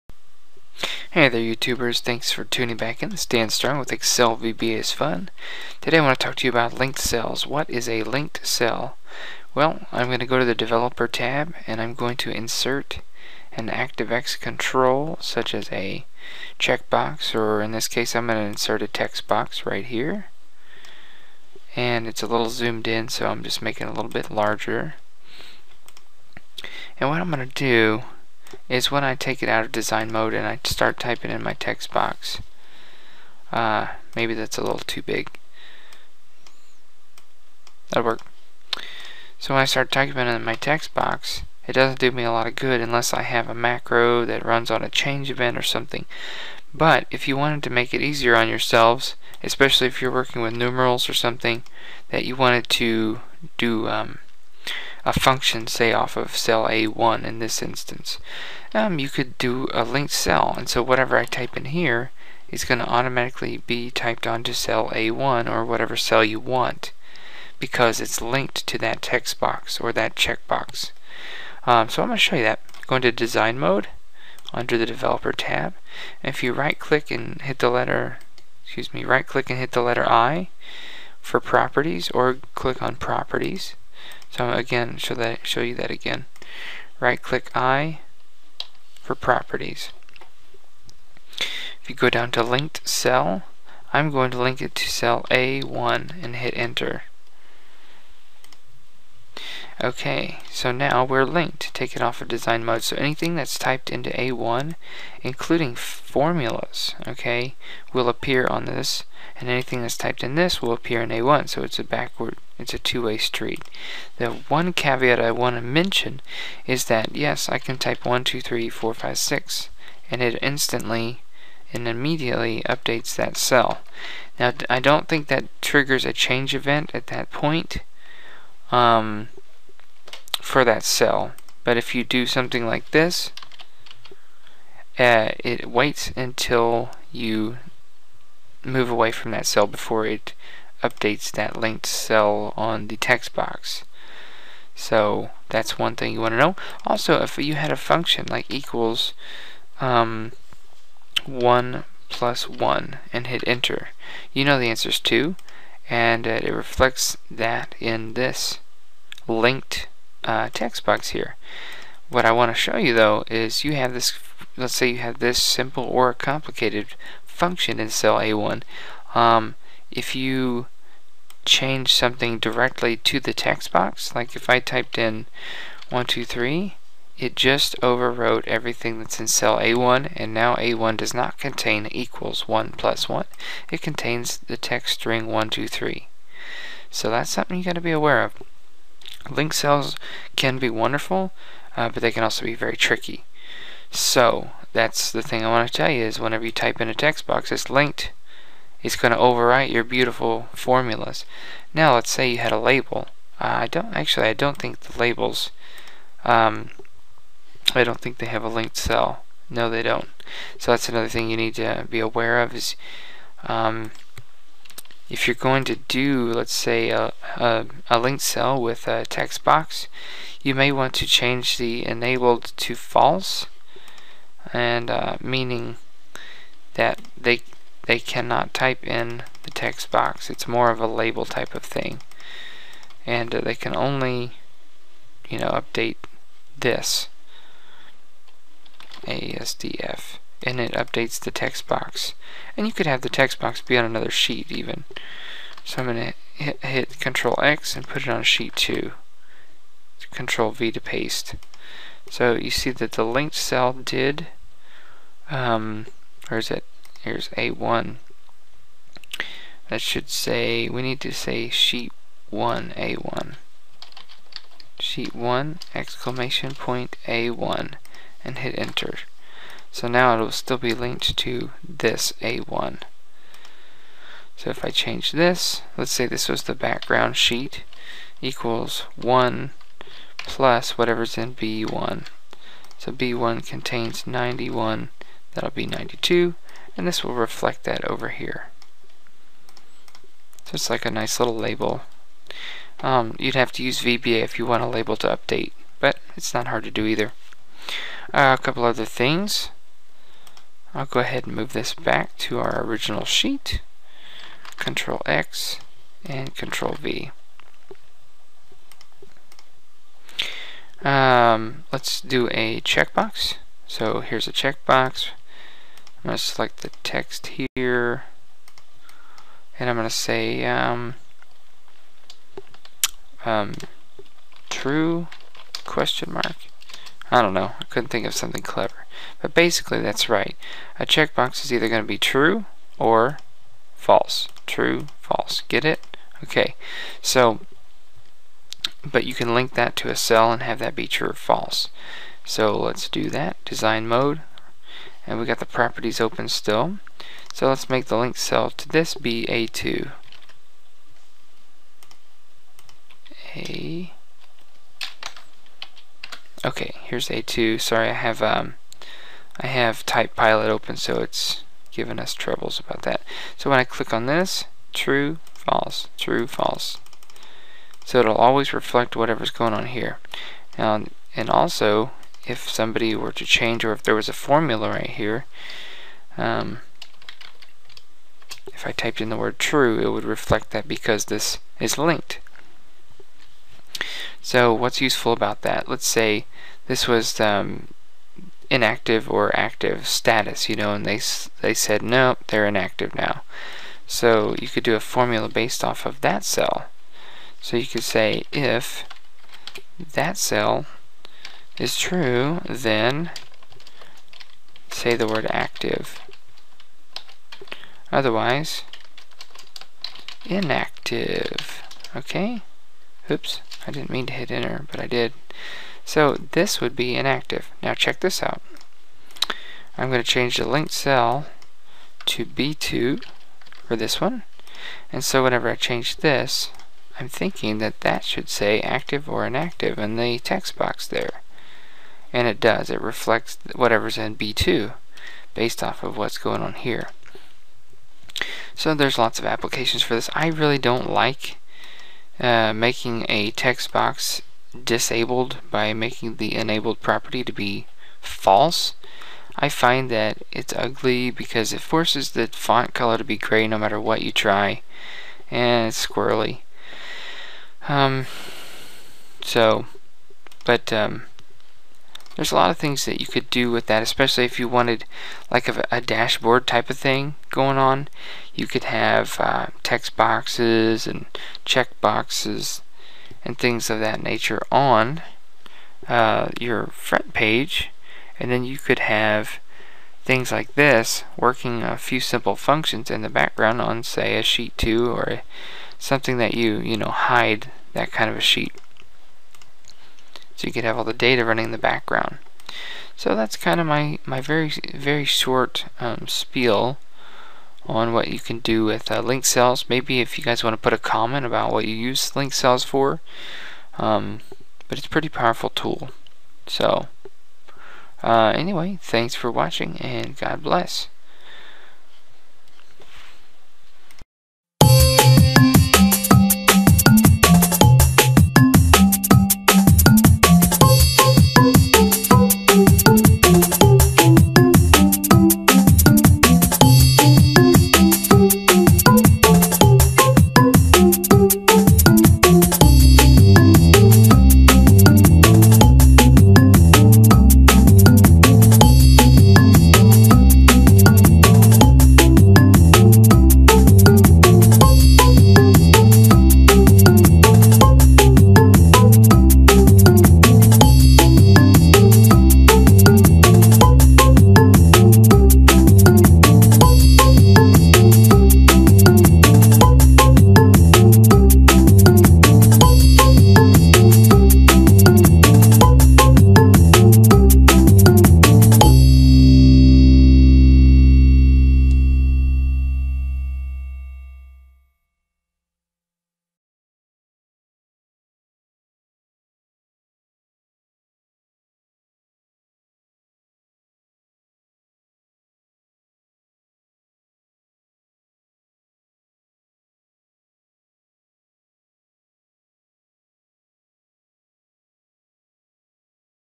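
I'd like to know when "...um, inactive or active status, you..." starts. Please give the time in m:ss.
6:27.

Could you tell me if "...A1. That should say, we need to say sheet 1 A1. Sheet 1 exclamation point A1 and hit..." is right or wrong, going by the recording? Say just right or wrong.
right.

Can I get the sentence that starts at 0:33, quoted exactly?
Uh, maybe that's a little too big.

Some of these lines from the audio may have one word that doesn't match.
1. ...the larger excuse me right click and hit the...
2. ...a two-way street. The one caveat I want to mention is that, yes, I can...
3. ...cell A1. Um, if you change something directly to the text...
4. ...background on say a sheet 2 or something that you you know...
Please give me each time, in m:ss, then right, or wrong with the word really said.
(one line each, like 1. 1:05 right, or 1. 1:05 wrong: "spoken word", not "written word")
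1. 1:17 wrong: "letter", not "larger"
2. 1:52 right
3. 2:47 right
4. 8:03 right.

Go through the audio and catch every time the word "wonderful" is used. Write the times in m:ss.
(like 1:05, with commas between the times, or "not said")
3:10.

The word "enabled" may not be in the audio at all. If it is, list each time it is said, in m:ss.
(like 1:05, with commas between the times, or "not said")
3:41, 7:26.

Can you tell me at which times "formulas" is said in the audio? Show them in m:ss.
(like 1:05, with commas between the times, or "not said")
1:45, 3:20, 6:14, 6:34.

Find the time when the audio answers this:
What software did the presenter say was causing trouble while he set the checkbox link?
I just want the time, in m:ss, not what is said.
5:59.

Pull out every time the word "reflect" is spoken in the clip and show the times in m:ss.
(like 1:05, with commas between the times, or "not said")
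2:36, 4:47, 6:08, 6:20, 7:12.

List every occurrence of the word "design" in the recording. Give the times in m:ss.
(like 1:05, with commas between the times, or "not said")
0:29, 1:13, 1:42, 5:43.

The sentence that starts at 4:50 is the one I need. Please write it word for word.
So it's like a nice little label.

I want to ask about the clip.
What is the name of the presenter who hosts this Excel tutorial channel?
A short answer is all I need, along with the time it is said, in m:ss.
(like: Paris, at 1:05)
Dan Strong, at 0:03.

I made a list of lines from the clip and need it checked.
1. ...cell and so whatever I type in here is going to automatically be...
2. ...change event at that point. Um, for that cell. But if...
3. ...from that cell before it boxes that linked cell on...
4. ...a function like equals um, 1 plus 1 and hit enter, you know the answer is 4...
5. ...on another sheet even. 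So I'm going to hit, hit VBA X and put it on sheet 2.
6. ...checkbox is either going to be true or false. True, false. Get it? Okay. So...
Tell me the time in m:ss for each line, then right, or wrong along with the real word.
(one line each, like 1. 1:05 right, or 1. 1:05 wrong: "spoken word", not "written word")
1. 1:00 right
2. 2:06 right
3. 2:19 wrong: "updates", not "boxes"
4. 2:27 wrong: "2", not "4"
5. 4:03 wrong: "Control", not "VBA"
6. 5:30 right.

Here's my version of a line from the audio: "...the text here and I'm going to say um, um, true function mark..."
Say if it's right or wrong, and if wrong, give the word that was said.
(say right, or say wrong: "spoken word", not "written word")
wrong: "question", not "function".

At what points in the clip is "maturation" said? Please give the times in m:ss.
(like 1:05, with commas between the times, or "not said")
not said.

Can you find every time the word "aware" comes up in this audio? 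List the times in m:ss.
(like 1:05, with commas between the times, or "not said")
3:07, 3:31.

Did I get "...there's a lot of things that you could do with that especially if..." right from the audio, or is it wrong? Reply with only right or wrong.
right.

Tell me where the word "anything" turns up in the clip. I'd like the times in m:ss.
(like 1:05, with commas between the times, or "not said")
1:42, 1:49.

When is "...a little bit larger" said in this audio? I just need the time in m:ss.
0:23.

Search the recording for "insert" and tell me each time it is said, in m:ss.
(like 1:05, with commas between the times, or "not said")
0:12, 0:18.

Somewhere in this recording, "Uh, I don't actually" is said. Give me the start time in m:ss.
3:23.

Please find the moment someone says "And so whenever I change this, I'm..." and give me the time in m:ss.
7:04.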